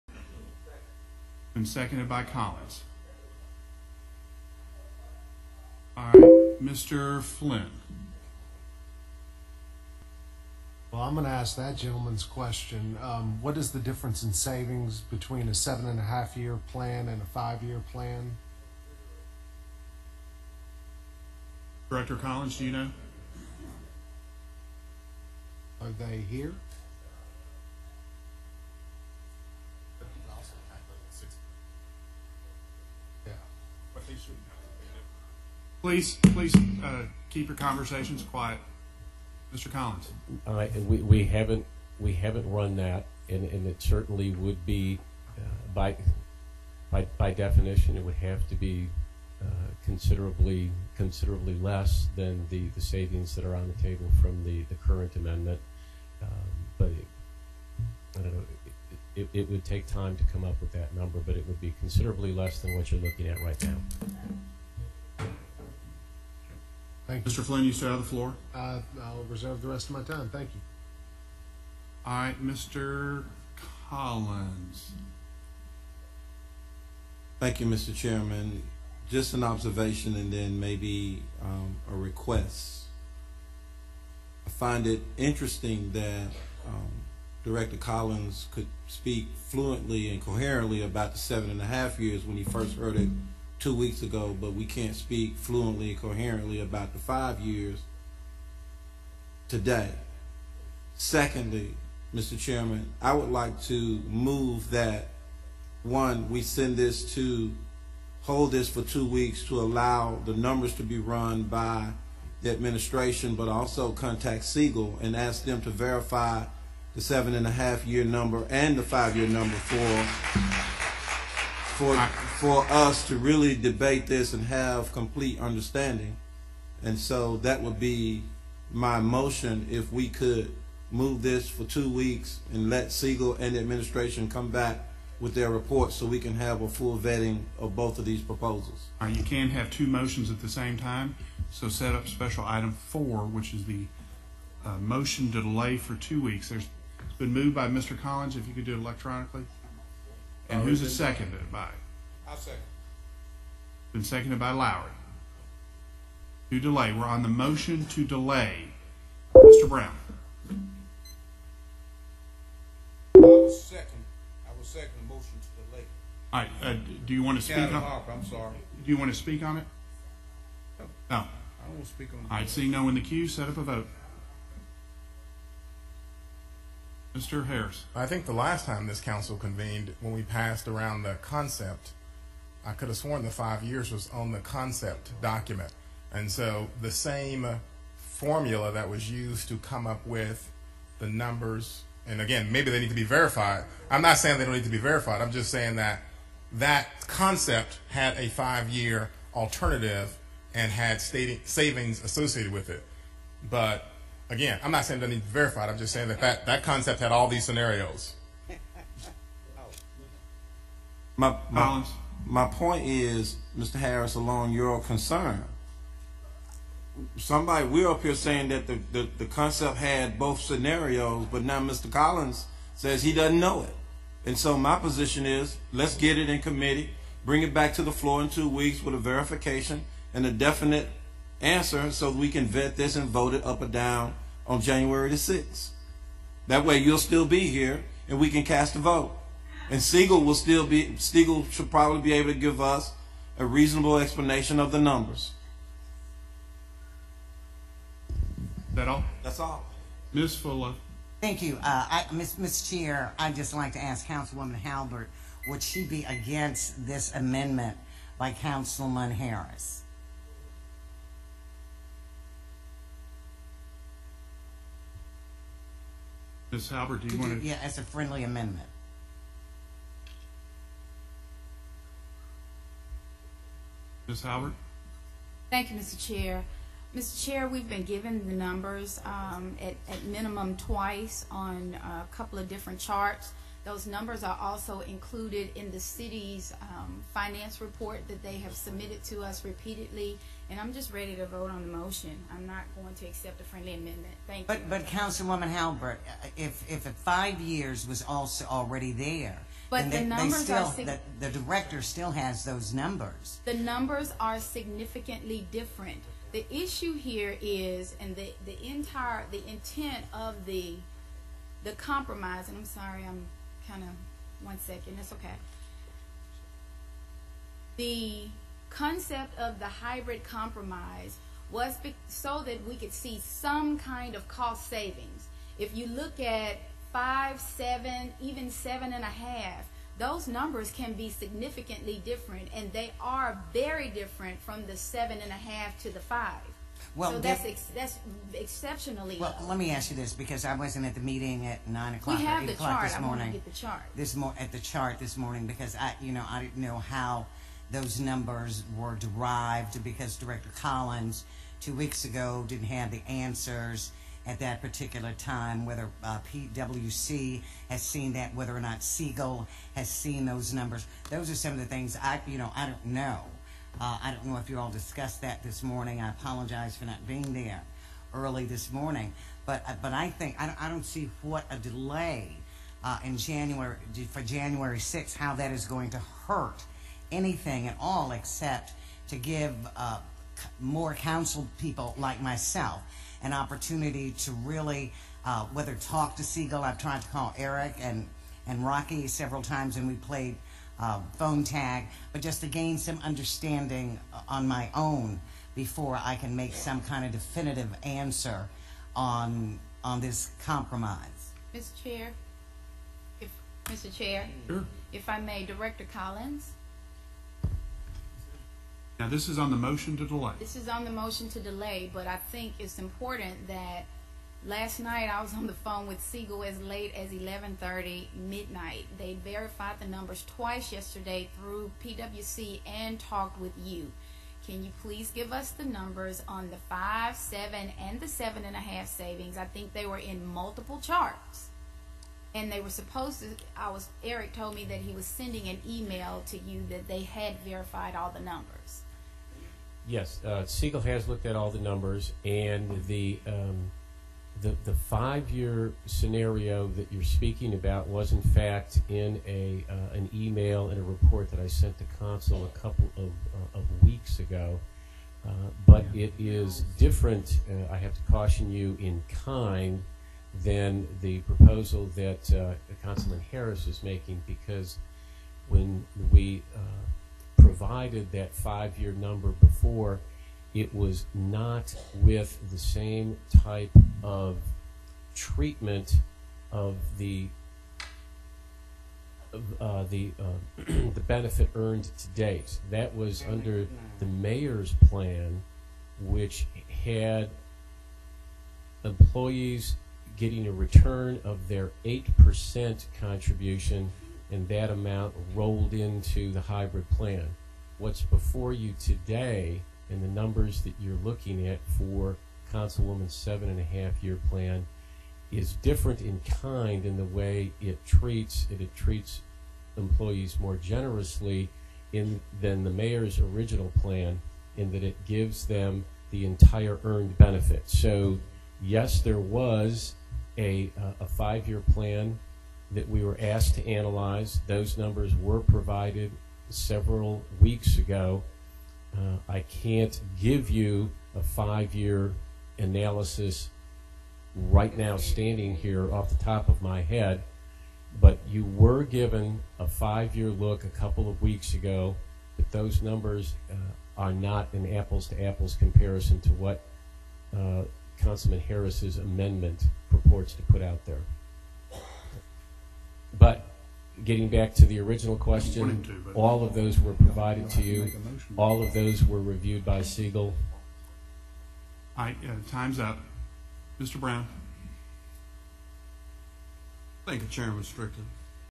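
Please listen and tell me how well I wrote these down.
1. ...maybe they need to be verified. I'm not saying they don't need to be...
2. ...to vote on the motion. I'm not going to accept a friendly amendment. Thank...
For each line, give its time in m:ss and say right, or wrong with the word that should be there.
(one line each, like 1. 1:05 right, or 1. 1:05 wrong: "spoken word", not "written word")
1. 3:12 right
2. 4:51 right.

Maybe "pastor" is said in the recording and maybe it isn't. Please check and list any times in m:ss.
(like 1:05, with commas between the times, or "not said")
not said.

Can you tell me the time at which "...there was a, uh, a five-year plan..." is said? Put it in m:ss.
8:39.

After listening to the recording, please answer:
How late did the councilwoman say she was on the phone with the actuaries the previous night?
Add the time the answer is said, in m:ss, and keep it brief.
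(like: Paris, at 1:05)
11:30, at 6:57.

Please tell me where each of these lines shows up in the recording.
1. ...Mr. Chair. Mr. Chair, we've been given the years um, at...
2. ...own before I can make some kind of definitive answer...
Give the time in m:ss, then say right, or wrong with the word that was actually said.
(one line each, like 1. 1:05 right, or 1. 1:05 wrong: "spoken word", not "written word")
1. 4:35 wrong: "numbers", not "years"
2. 6:34 right.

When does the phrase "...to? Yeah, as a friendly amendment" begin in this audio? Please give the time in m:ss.
4:27.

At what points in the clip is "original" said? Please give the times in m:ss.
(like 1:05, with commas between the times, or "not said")
8:33, 9:14.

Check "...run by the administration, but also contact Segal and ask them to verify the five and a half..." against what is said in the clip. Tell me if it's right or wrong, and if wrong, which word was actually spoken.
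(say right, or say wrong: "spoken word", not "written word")
wrong: "seven", not "five".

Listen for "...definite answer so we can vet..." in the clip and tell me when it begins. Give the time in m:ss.
3:50.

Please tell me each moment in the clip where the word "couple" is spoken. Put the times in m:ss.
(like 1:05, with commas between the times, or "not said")
4:42, 7:32, 9:00.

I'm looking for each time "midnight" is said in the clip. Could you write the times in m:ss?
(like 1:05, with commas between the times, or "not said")
6:58.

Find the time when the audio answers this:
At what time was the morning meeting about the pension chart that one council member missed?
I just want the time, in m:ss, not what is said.
5:41.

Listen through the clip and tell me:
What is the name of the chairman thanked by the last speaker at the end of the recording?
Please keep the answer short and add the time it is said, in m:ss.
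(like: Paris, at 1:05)
Strickland, at 9:27.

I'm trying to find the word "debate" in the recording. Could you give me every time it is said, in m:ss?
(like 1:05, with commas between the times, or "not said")
2:03.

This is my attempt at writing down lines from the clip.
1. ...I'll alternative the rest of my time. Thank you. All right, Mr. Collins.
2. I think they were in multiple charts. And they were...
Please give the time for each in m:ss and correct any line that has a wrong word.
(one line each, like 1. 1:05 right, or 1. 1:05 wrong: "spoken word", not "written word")
1. 1:09 wrong: "reserve", not "alternative"
2. 7:09 right.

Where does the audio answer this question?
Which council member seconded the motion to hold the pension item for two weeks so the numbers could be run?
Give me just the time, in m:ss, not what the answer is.
2:34.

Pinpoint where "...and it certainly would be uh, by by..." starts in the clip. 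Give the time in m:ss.
0:43.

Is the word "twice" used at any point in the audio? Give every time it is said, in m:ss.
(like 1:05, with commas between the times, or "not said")
4:40, 7:00.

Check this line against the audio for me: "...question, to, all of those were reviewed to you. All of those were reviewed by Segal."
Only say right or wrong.
wrong.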